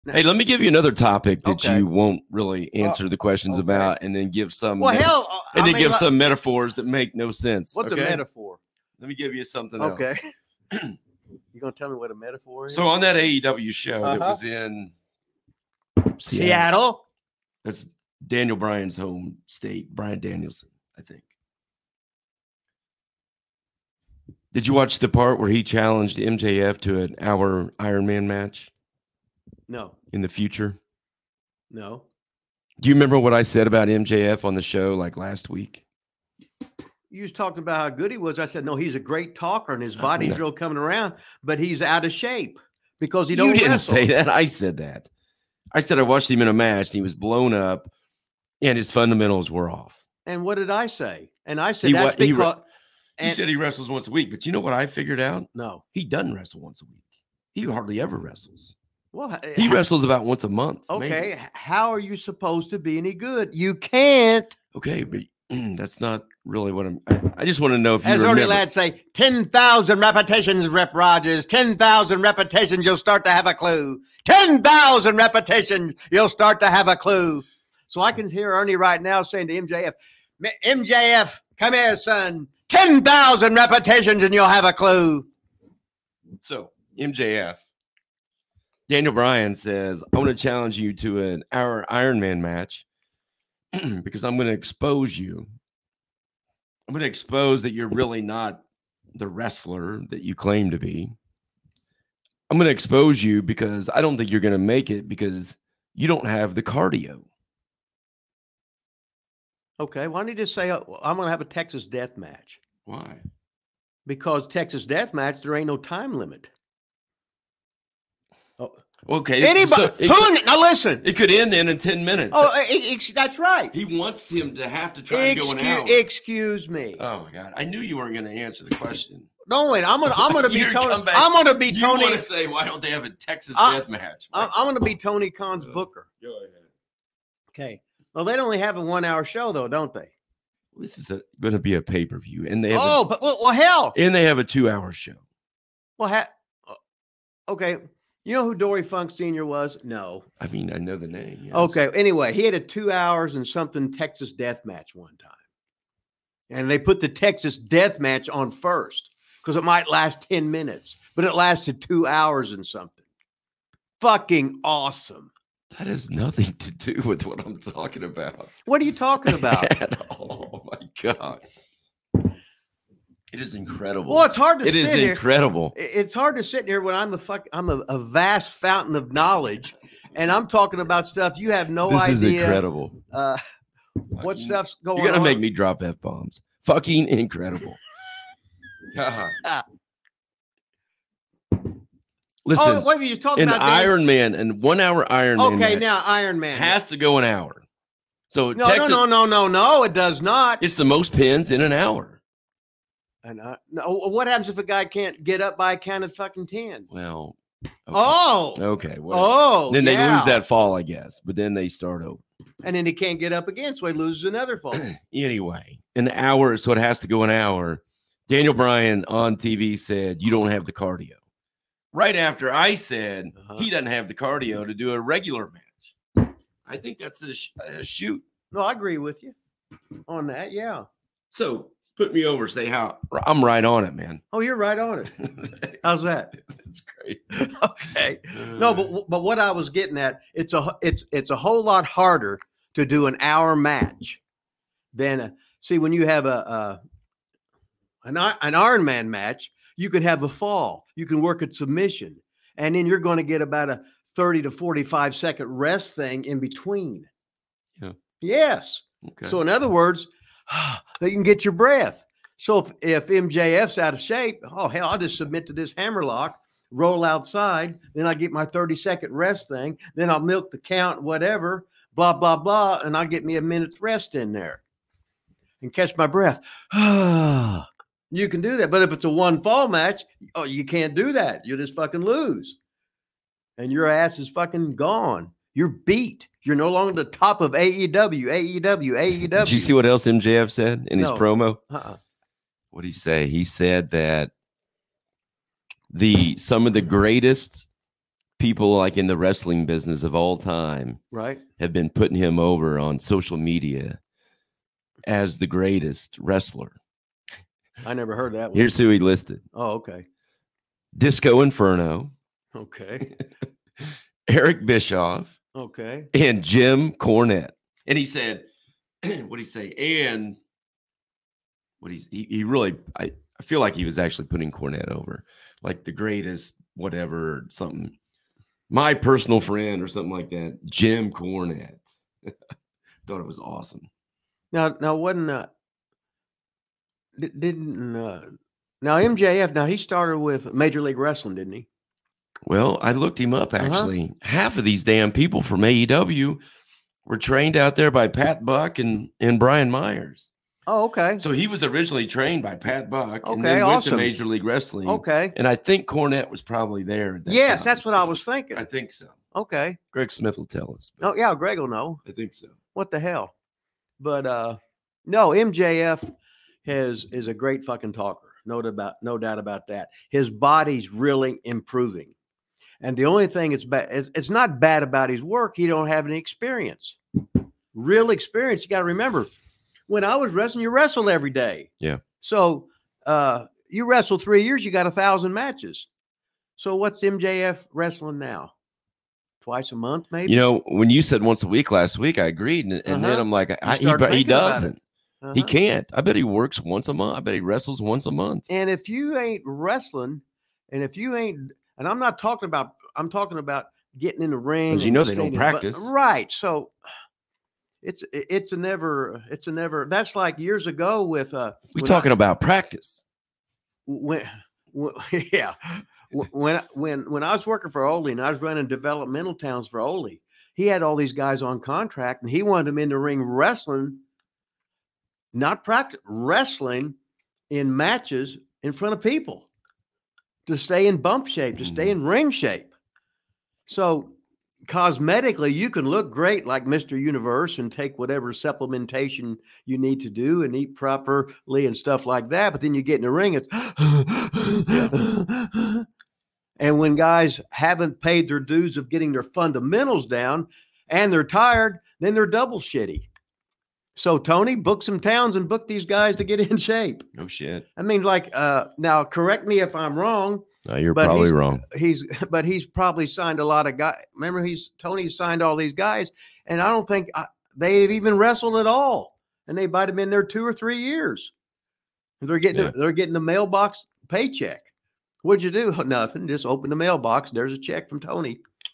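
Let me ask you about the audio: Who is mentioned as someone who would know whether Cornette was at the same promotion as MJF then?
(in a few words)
Greg Smith.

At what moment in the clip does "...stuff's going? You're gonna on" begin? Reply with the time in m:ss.
3:04.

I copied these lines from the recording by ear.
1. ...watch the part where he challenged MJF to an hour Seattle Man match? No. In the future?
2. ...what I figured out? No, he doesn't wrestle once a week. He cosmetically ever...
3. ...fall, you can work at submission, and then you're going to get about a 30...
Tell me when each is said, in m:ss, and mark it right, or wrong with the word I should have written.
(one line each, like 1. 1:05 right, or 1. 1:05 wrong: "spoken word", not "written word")
1. 0:24 wrong: "Iron", not "Seattle"
2. 0:54 wrong: "hardly", not "cosmetically"
3. 4:10 right.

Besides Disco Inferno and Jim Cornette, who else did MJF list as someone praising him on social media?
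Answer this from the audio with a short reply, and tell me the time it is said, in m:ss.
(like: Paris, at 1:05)
Eric Bischoff, at 5:14.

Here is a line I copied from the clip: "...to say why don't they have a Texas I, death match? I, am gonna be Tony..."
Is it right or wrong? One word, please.
right.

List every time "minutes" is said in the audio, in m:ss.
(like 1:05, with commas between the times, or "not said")
2:02, 2:40, 4:33.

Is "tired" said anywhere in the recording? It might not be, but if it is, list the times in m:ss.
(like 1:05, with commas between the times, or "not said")
7:31.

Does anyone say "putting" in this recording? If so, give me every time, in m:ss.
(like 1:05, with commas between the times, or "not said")
5:01, 5:24.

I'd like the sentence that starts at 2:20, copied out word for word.
this is going to be a pay-per-view, and they oh, a, but well, well, hell, and they have a two-hour show.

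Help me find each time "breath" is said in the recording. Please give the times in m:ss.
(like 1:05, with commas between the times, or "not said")
4:21, 4:36.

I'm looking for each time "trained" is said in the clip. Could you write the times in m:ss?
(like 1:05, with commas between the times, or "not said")
5:47, 5:52.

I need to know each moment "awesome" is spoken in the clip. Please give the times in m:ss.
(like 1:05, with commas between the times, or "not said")
2:44, 5:33, 5:53.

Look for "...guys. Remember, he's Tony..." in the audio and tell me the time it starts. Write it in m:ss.
7:43.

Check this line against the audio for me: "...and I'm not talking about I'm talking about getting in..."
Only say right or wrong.
right.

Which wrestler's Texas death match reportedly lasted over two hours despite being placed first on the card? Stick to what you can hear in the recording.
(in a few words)
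Dory Funk Sr.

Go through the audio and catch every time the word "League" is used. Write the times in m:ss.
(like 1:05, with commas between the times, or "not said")
5:40, 5:54.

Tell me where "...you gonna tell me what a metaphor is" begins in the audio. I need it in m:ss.
0:10.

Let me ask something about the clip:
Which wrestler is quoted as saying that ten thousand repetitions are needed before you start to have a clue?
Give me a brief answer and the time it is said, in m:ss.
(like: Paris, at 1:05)
Ernie Ladd, at 1:08.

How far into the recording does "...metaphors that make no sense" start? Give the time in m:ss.
0:06.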